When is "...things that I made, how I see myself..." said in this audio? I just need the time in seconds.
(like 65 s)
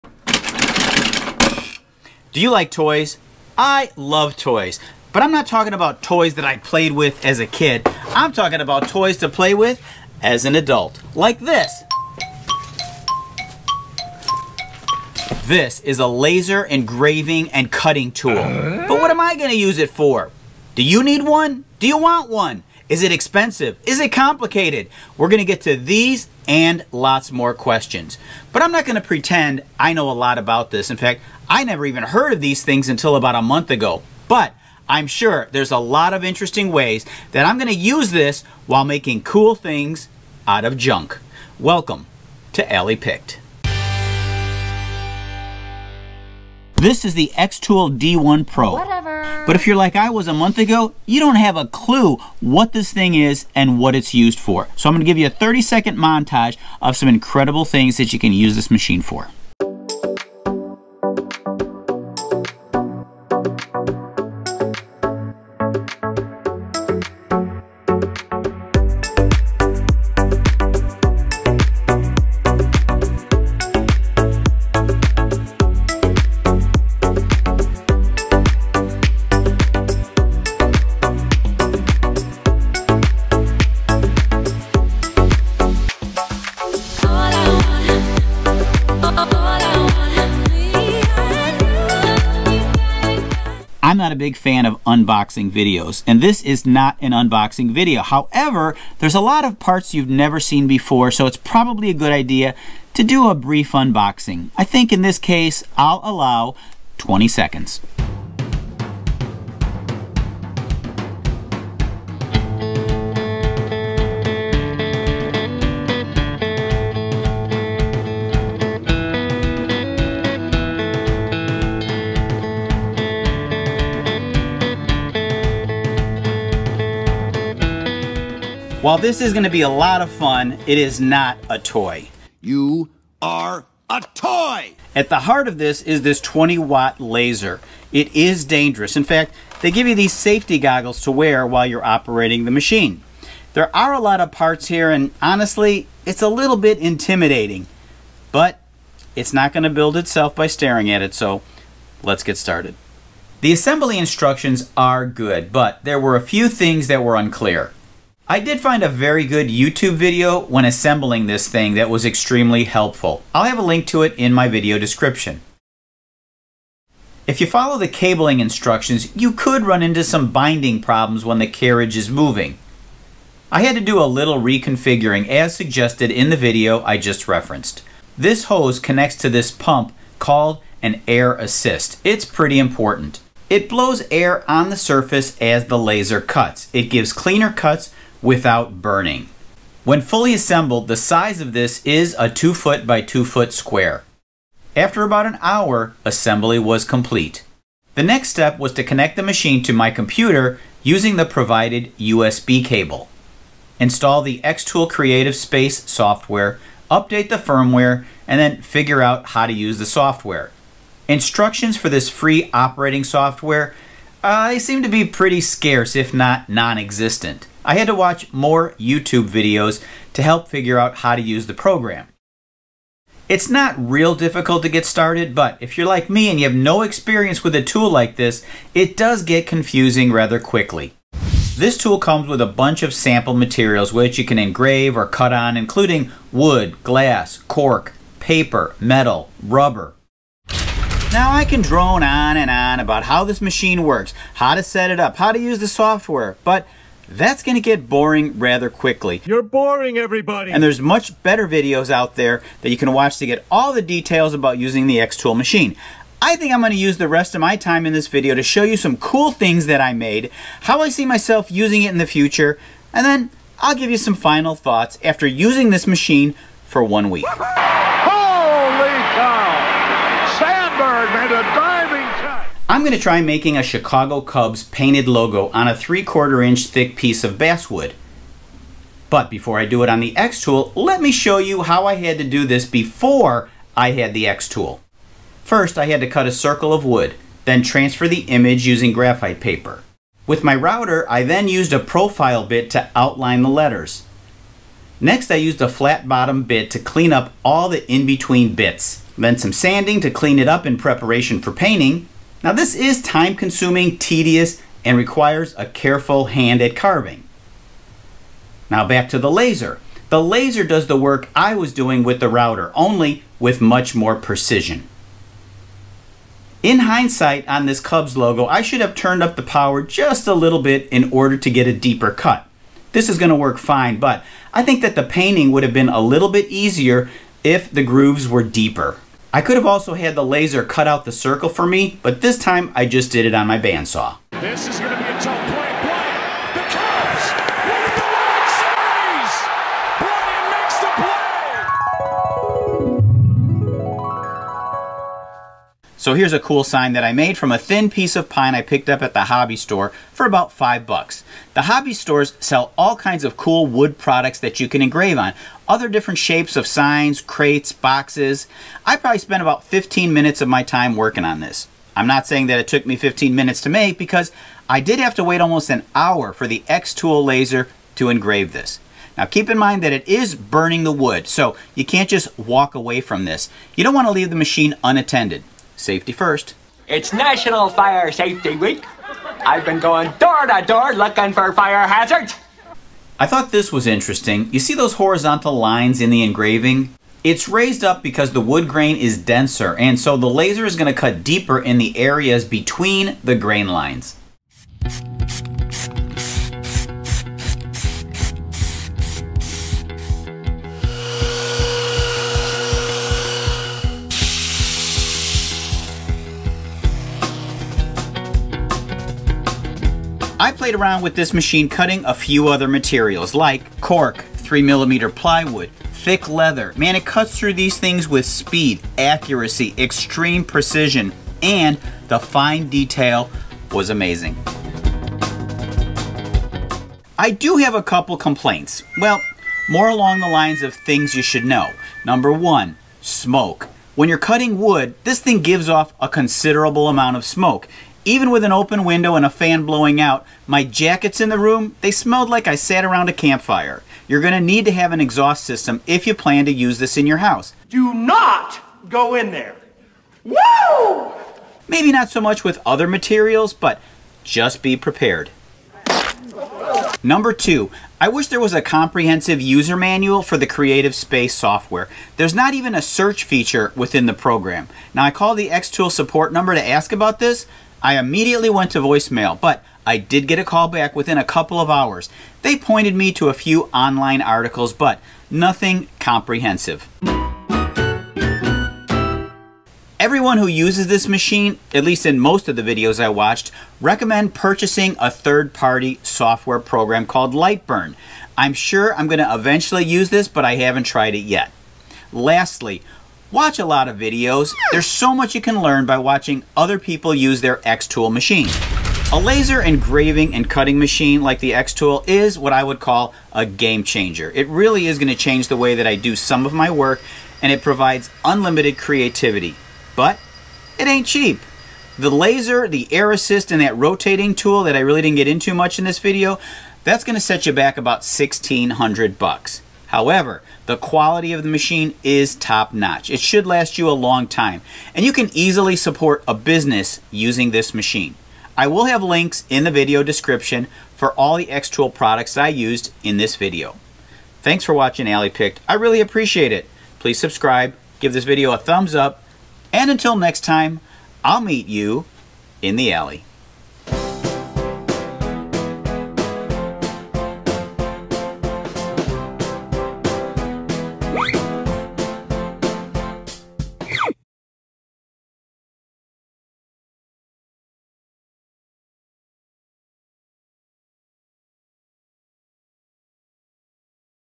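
259 s.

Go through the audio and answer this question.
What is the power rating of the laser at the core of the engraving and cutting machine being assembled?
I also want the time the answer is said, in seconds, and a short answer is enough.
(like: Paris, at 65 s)
20 watt, at 136 s.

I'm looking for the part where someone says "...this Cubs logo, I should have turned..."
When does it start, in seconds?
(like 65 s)
317 s.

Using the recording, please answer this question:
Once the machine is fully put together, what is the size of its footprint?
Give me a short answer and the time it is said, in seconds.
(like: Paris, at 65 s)
2 foot by 2 foot, at 192 s.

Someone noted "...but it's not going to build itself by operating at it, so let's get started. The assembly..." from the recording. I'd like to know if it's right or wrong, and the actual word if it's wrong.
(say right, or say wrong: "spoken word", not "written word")
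wrong: "staring", not "operating".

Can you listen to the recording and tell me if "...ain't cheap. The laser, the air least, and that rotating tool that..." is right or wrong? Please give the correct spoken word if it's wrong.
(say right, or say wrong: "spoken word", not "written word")
wrong: "assist", not "least".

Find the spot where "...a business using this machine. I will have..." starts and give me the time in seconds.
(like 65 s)
526 s.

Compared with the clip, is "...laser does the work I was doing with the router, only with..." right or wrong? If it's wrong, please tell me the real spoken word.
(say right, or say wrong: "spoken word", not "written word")
right.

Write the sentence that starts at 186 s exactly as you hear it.
It gives cleaner cuts without burning.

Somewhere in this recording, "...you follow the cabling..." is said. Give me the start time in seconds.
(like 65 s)
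167 s.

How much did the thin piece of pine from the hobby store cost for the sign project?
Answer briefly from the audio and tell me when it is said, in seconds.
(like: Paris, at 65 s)
5 dollars, at 350 s.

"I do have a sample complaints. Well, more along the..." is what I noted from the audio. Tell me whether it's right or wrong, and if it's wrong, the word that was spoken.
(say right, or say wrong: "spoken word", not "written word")
wrong: "couple", not "sample".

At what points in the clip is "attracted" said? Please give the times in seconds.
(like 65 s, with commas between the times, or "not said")
not said.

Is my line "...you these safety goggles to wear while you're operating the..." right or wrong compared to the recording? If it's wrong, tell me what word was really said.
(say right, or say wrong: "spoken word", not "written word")
right.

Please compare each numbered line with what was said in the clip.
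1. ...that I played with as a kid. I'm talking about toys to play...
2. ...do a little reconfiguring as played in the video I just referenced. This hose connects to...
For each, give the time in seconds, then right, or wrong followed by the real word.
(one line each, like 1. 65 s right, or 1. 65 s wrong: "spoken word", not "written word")
1. 6 s right
2. 173 s wrong: "suggested", not "played".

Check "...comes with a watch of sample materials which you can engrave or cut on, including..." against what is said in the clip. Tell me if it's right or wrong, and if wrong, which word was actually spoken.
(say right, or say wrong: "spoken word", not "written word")
wrong: "bunch", not "watch".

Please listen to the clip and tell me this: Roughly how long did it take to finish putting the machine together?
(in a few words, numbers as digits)
about an hour.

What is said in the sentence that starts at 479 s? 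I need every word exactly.
Everyone who uses this machine, at least in most of the videos I watched, recommend purchasing a third-party software program called Lightburn.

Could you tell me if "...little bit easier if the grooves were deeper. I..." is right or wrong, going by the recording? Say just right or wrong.
right.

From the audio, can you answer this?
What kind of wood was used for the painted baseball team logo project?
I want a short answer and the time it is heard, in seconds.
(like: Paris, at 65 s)
basswood, at 277 s.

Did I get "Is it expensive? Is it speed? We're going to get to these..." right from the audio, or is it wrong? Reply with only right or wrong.
wrong.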